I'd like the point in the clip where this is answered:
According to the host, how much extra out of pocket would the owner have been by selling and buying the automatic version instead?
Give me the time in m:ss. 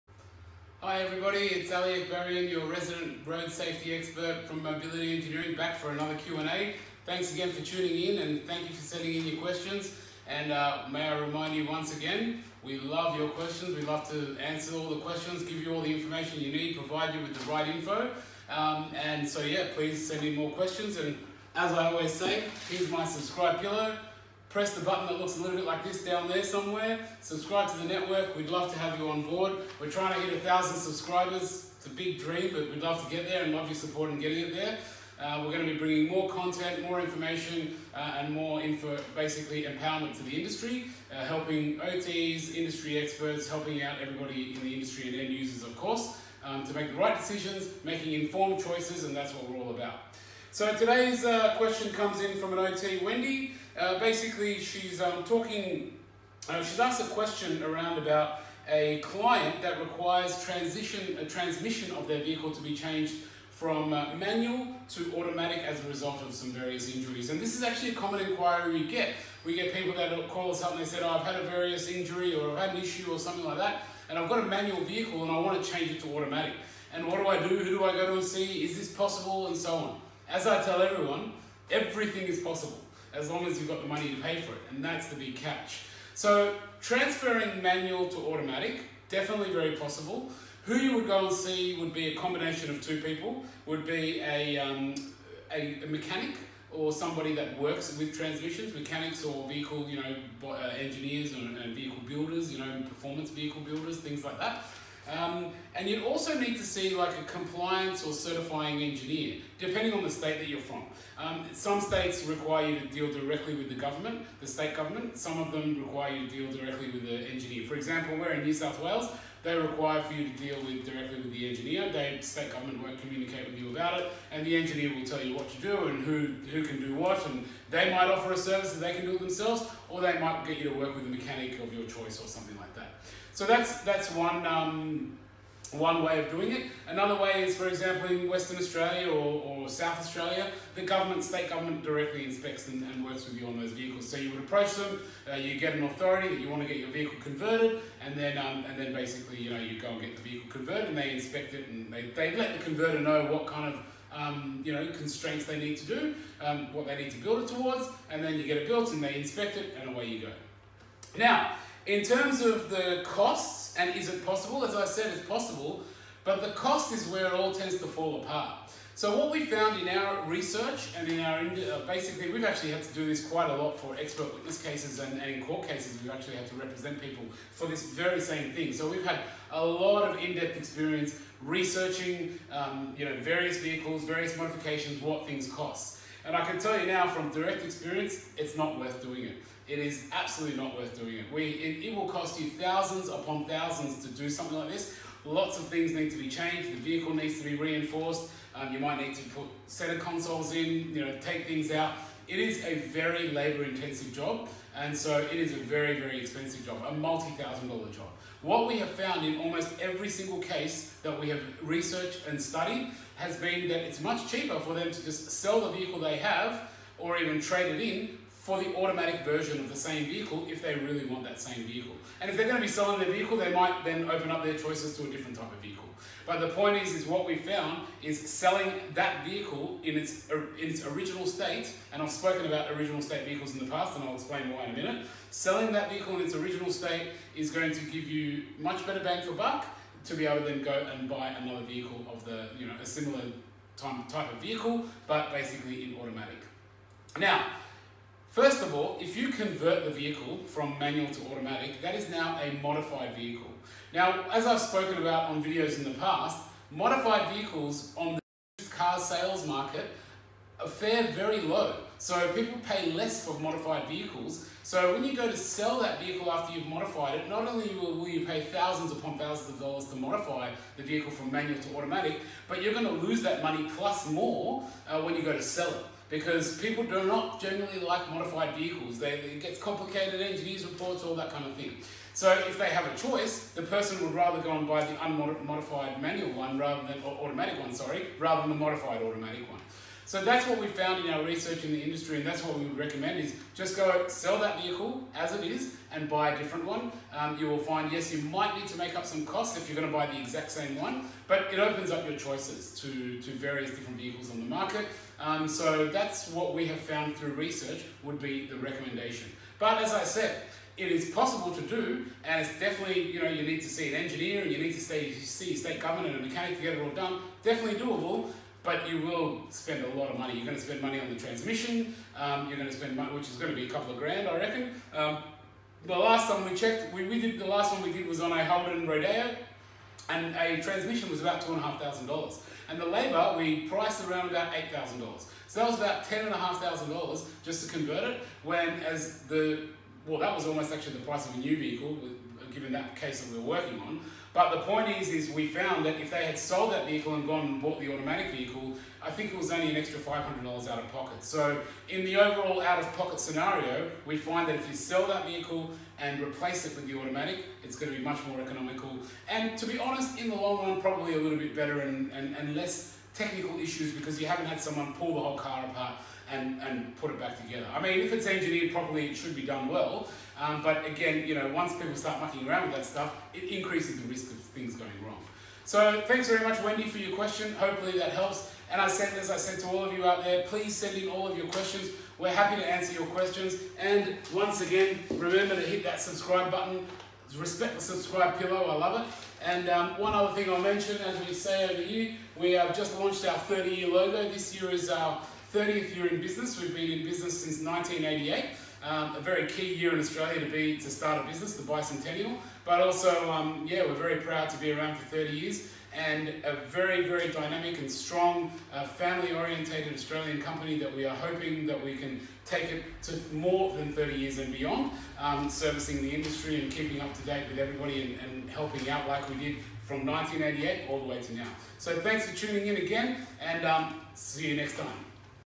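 5:49.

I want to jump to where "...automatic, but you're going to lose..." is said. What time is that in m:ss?
4:31.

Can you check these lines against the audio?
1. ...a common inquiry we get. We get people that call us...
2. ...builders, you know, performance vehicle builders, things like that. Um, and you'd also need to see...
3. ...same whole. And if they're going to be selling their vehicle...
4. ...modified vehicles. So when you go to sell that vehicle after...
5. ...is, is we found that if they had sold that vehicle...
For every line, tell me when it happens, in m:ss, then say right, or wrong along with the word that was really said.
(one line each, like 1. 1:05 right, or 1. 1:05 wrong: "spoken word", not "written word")
1. 1:07 right
2. 1:42 right
3. 3:41 wrong: "vehicle", not "whole"
4. 4:23 right
5. 5:45 right.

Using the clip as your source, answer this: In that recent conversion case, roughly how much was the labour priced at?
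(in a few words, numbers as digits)
$8000.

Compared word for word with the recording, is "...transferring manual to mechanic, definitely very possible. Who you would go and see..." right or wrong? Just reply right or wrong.
wrong.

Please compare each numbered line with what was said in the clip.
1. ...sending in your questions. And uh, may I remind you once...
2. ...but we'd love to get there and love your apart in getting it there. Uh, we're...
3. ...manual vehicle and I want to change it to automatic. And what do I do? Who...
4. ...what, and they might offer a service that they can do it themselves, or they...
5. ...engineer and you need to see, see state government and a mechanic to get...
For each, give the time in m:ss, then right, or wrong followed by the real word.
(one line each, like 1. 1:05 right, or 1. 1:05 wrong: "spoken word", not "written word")
1. 0:08 right
2. 0:32 wrong: "support", not "apart"
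3. 1:14 right
4. 2:06 right
5. 5:14 right.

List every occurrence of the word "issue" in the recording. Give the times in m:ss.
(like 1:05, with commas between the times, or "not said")
1:12, 6:03.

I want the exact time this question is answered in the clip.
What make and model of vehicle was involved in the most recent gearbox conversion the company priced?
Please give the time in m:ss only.
5:28.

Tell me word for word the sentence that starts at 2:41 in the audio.
Now, in terms of the costs, and is it possible?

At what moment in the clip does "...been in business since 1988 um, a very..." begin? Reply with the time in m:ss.
6:36.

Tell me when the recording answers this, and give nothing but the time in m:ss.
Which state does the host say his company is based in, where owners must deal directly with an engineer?
1:58.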